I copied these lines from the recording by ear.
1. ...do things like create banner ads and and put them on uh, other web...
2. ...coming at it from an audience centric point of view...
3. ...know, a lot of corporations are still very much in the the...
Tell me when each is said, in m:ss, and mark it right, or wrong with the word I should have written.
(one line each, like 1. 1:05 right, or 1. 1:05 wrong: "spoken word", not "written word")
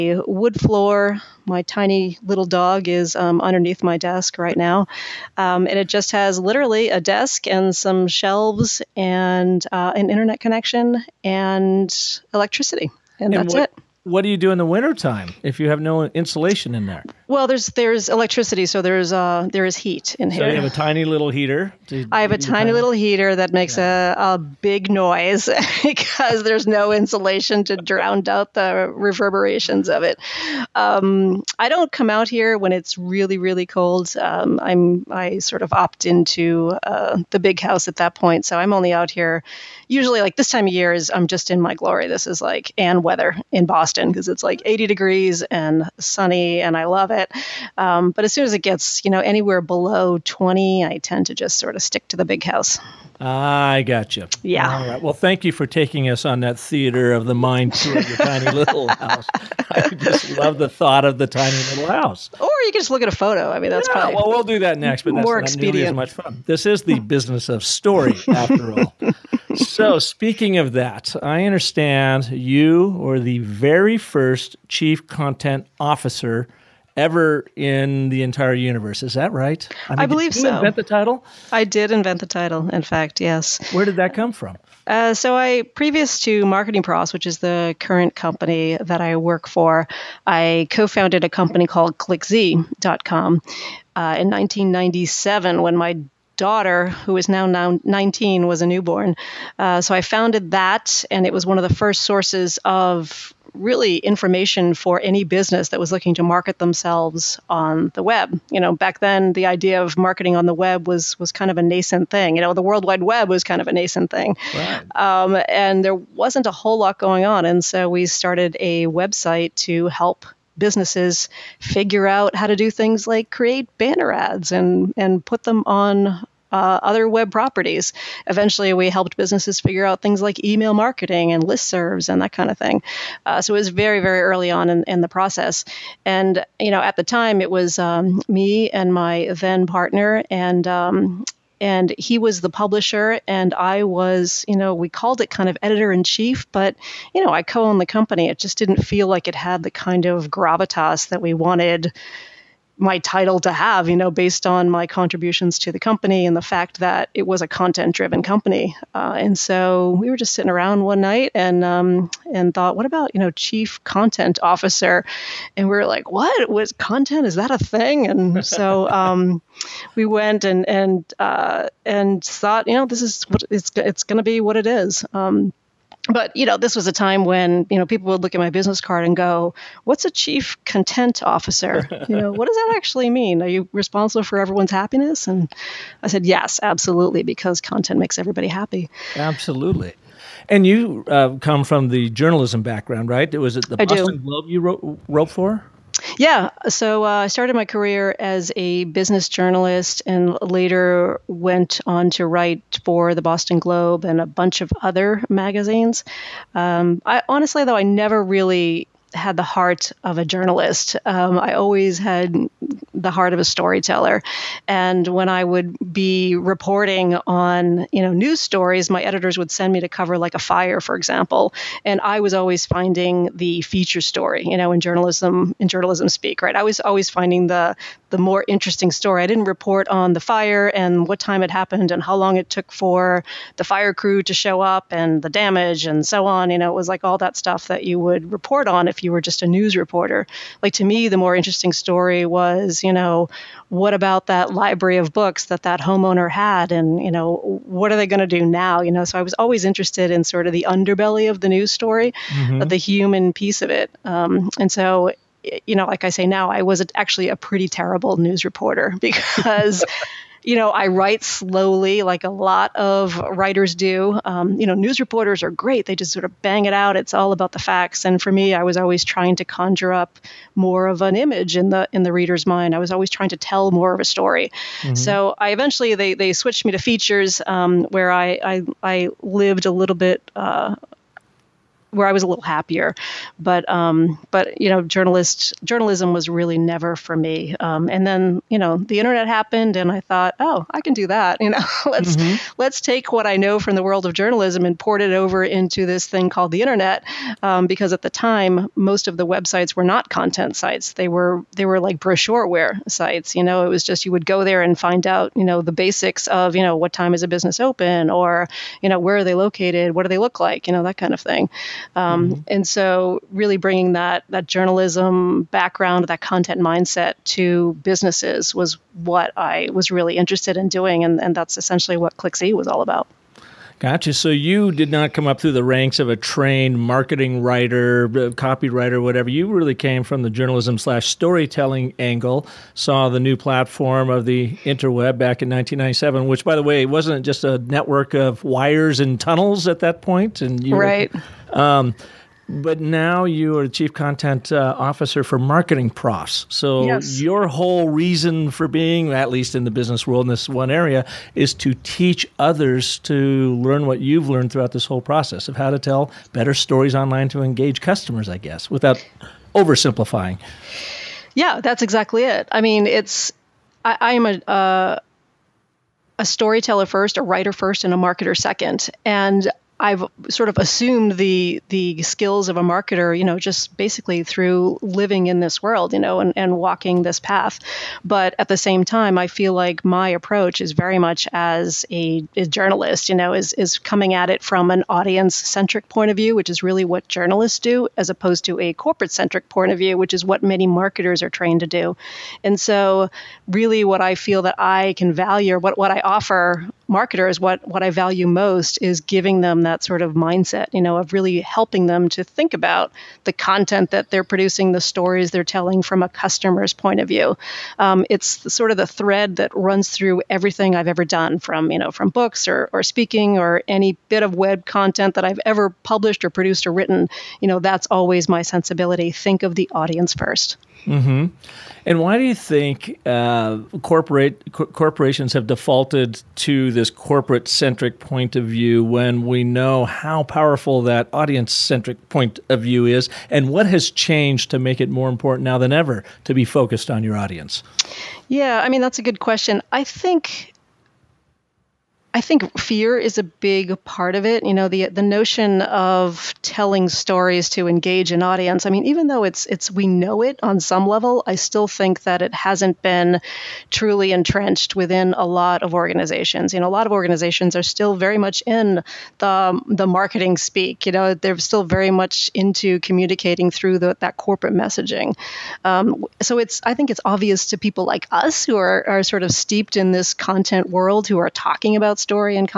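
1. 2:02 right
2. 6:23 right
3. 7:36 wrong: "organizations", not "corporations".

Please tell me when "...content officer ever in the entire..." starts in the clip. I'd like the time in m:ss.
1:15.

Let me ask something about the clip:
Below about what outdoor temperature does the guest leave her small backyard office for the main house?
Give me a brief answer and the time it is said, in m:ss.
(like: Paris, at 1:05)
20, at 0:50.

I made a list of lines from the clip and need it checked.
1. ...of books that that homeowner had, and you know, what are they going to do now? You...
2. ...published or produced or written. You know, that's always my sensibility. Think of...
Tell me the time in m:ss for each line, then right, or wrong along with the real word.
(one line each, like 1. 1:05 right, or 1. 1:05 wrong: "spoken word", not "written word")
1. 4:04 right
2. 6:55 right.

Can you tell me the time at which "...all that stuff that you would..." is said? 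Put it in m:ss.
3:57.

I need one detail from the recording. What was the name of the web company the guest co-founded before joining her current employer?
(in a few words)
ClickZ.com.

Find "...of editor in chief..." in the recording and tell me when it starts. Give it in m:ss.
2:25.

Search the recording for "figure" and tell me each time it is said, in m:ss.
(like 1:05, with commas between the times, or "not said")
2:01, 2:09.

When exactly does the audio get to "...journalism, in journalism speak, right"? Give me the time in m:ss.
3:44.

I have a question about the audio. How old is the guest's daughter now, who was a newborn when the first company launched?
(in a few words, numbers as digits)
19.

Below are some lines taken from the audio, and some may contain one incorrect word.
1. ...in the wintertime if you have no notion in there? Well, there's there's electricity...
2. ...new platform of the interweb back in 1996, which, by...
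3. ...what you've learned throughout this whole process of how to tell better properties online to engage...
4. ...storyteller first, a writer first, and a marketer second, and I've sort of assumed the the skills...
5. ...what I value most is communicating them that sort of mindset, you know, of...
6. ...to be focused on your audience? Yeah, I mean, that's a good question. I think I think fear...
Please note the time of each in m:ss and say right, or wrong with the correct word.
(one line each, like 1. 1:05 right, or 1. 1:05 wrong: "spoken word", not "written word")
1. 0:14 wrong: "insulation", not "notion"
2. 5:33 wrong: "1997", not "1996"
3. 5:53 wrong: "stories", not "properties"
4. 6:06 right
5. 6:37 wrong: "giving", not "communicating"
6. 7:16 right.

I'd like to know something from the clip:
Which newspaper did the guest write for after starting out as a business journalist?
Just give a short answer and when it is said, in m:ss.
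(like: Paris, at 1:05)
Boston Globe, at 3:23.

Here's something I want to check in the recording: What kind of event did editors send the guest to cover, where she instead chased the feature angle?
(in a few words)
A fire.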